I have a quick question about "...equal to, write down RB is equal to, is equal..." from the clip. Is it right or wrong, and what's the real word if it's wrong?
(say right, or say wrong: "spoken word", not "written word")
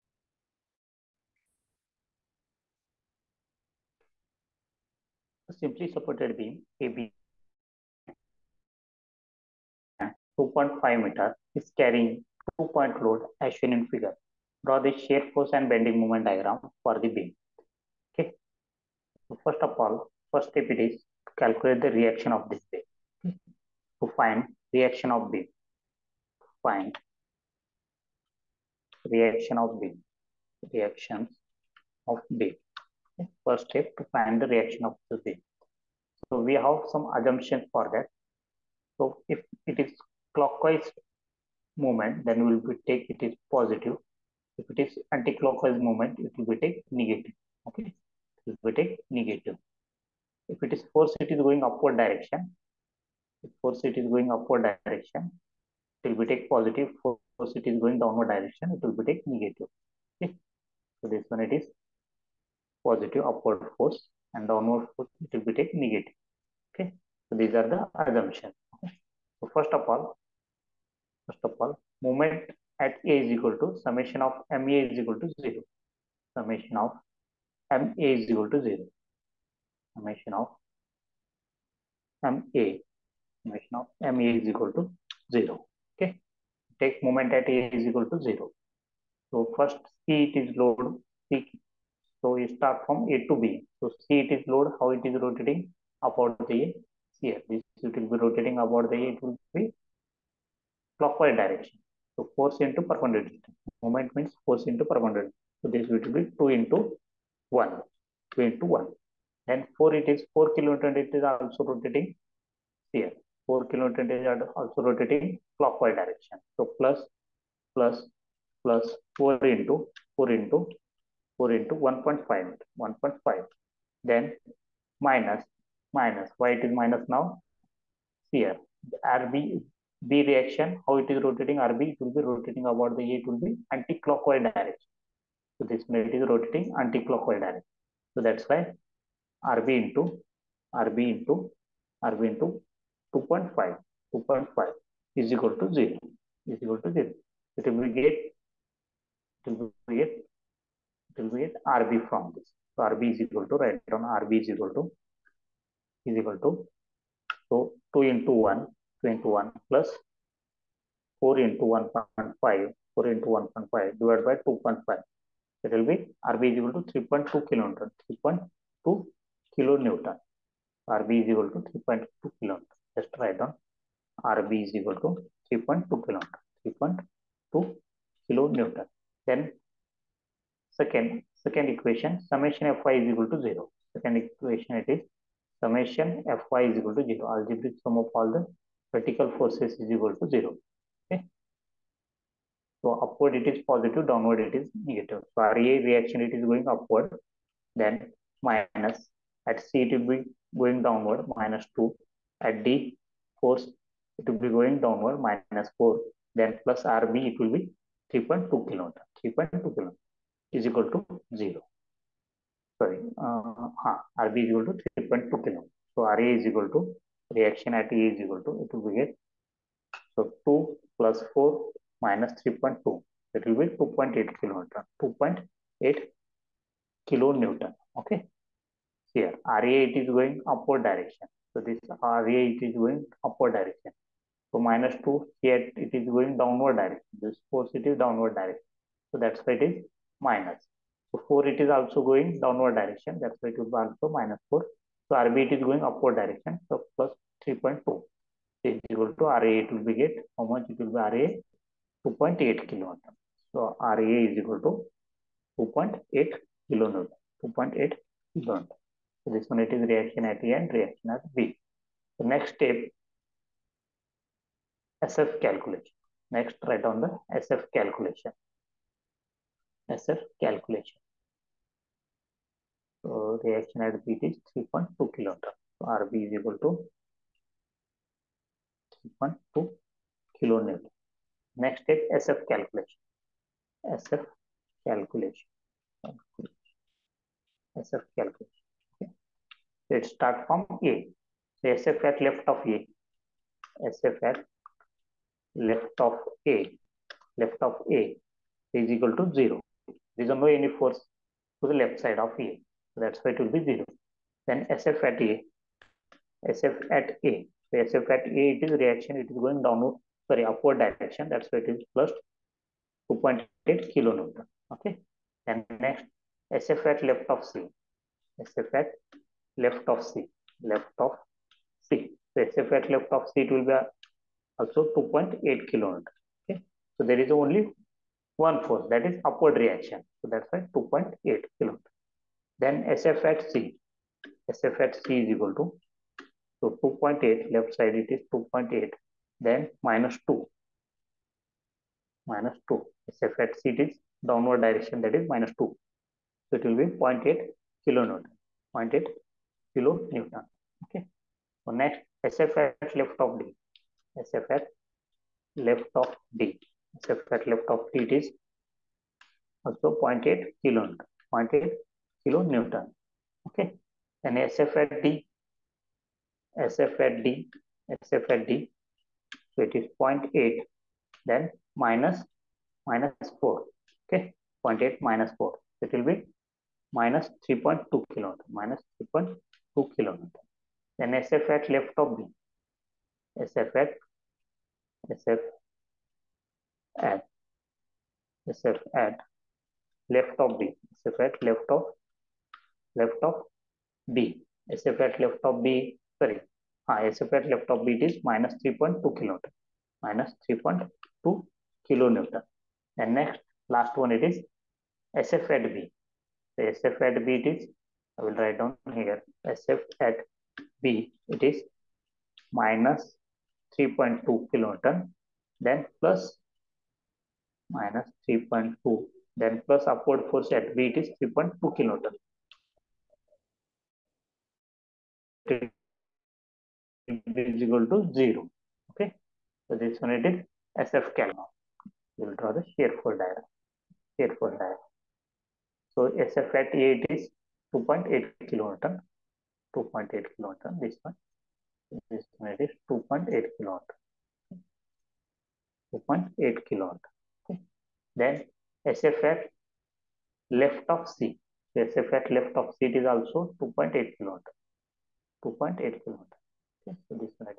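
right.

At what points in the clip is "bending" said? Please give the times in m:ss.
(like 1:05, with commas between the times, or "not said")
0:15.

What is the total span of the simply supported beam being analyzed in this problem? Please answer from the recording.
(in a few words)
2.5 meters.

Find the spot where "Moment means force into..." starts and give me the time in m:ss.
1:43.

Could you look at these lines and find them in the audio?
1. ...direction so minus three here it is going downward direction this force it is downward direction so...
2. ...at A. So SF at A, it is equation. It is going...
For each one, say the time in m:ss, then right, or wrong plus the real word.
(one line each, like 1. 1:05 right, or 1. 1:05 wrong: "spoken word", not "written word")
1. 3:53 wrong: "two", not "three"
2. 5:06 wrong: "reaction", not "equation".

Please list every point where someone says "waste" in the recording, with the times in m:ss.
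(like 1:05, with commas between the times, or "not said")
not said.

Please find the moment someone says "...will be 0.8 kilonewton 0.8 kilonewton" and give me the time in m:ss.
5:46.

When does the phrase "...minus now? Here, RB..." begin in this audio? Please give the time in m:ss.
2:06.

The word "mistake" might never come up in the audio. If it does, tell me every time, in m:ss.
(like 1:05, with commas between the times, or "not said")
not said.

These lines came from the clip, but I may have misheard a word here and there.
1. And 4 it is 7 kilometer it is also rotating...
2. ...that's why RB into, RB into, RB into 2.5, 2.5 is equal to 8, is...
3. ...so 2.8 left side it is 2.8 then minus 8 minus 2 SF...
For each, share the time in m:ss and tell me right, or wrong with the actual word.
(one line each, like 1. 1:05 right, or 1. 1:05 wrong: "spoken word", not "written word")
1. 1:49 wrong: "4", not "7"
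2. 2:18 wrong: "0", not "8"
3. 5:36 wrong: "2", not "8".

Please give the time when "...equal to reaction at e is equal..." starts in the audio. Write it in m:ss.
3:36.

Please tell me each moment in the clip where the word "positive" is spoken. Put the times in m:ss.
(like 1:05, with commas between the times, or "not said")
0:43, 0:56, 1:02, 3:13.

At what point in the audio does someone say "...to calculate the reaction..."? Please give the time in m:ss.
0:21.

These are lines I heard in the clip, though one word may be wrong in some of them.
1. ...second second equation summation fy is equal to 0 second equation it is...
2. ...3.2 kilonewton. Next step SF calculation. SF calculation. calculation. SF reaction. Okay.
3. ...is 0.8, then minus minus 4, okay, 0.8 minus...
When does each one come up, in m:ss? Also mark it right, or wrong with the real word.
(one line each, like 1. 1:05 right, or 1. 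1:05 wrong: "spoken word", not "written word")
1. 3:00 right
2. 4:39 wrong: "calculation", not "reaction"
3. 6:09 right.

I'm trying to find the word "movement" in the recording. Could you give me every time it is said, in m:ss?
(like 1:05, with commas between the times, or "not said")
0:41, 0:45.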